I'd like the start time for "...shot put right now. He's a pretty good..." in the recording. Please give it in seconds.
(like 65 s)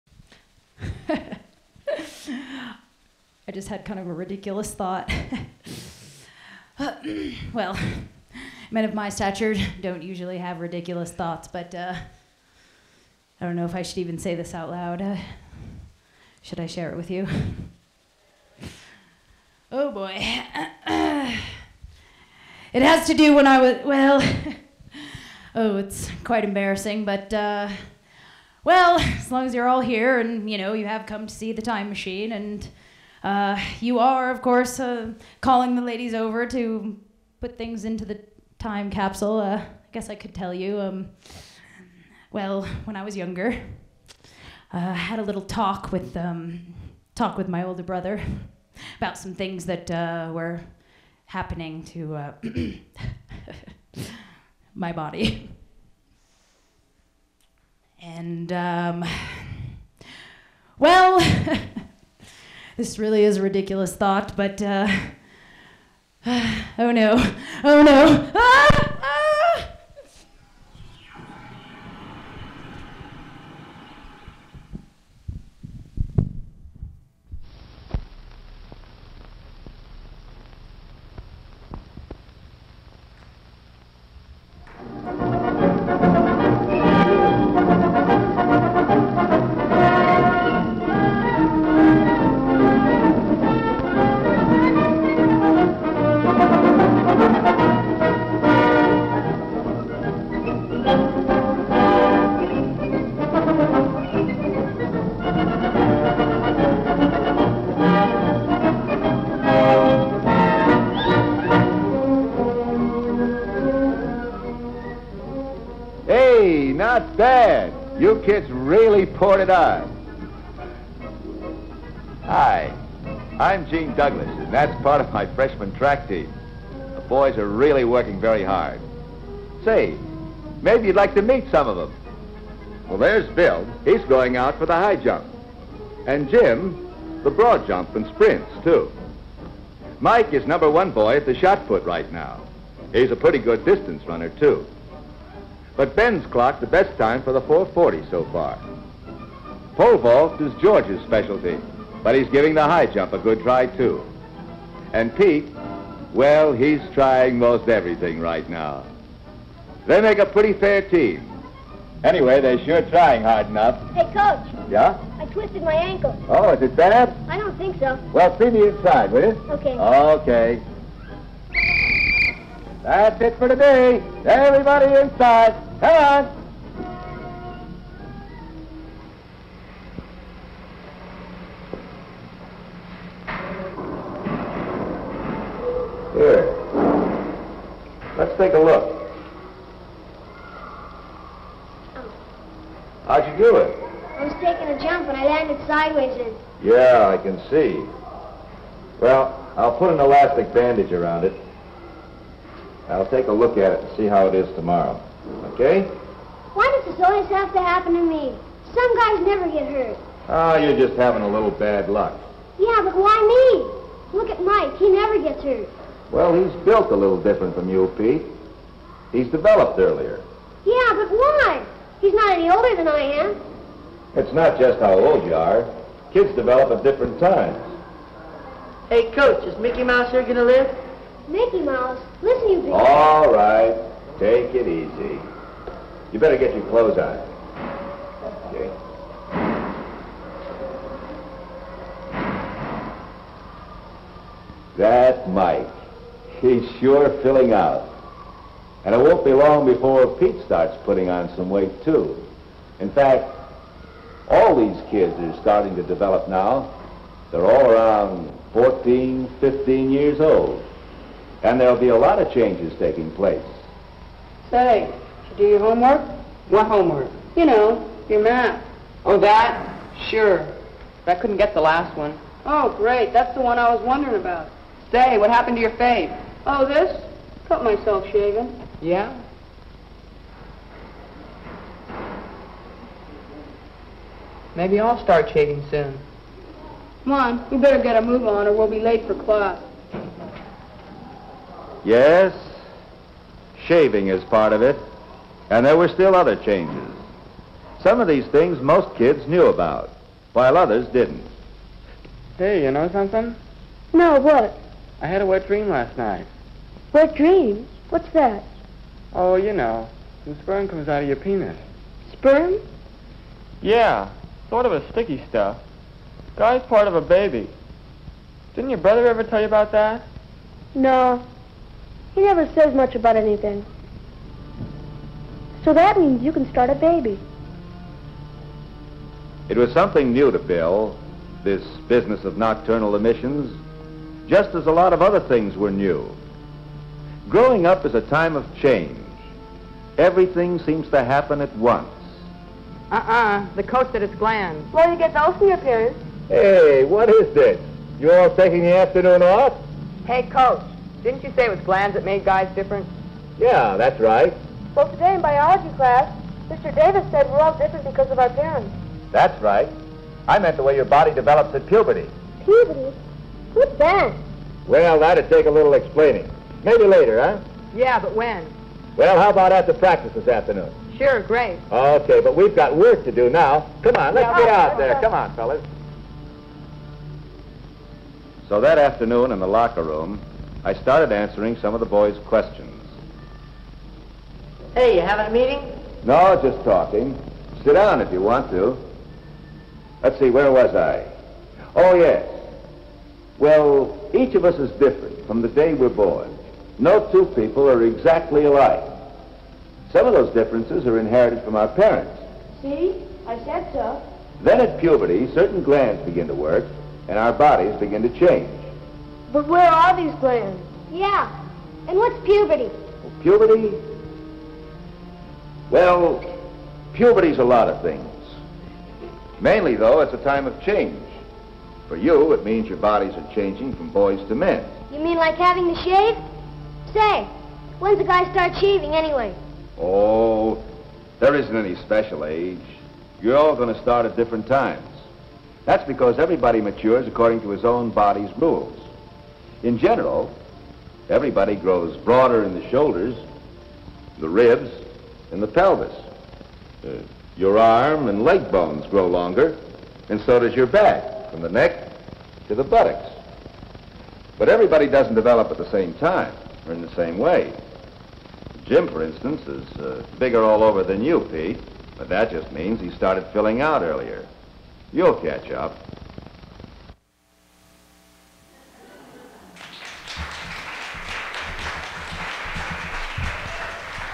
141 s.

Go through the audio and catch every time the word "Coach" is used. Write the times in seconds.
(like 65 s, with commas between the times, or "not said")
164 s, 229 s, 350 s.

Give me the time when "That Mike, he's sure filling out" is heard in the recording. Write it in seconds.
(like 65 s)
244 s.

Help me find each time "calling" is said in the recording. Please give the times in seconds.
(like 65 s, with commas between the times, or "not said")
35 s.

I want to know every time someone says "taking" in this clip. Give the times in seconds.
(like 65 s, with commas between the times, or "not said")
194 s, 262 s, 348 s.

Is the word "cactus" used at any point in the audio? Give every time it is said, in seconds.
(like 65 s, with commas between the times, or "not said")
not said.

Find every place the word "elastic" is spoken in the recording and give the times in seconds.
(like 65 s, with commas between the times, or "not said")
199 s.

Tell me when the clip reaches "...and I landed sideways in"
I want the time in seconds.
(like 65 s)
195 s.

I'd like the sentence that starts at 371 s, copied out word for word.
Okay, but we've got work to do now.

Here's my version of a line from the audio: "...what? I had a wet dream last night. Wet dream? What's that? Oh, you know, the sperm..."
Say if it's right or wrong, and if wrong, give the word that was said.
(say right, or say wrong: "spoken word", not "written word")
right.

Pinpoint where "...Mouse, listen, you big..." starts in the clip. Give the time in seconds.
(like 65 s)
231 s.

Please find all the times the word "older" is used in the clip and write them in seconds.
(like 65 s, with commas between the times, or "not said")
47 s, 222 s.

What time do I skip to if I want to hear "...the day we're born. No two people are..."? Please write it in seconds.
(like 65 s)
395 s.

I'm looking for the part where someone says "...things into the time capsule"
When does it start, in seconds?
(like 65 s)
37 s.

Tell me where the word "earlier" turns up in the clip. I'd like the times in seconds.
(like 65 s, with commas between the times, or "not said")
219 s, 463 s.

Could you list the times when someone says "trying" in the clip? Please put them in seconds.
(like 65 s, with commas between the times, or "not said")
156 s, 162 s.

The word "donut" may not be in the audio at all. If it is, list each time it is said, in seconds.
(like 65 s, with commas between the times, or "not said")
not said.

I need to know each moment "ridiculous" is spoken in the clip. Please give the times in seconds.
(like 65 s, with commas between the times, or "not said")
4 s, 10 s, 63 s.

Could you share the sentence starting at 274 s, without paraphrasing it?
Say, what happened to your fave?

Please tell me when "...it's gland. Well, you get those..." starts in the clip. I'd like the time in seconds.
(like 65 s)
344 s.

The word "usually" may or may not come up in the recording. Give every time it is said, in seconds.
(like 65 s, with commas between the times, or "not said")
10 s.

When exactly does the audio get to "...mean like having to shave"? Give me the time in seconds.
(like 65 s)
424 s.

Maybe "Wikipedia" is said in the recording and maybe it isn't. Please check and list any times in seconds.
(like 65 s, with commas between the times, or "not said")
not said.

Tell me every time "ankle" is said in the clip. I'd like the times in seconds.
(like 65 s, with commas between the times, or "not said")
165 s.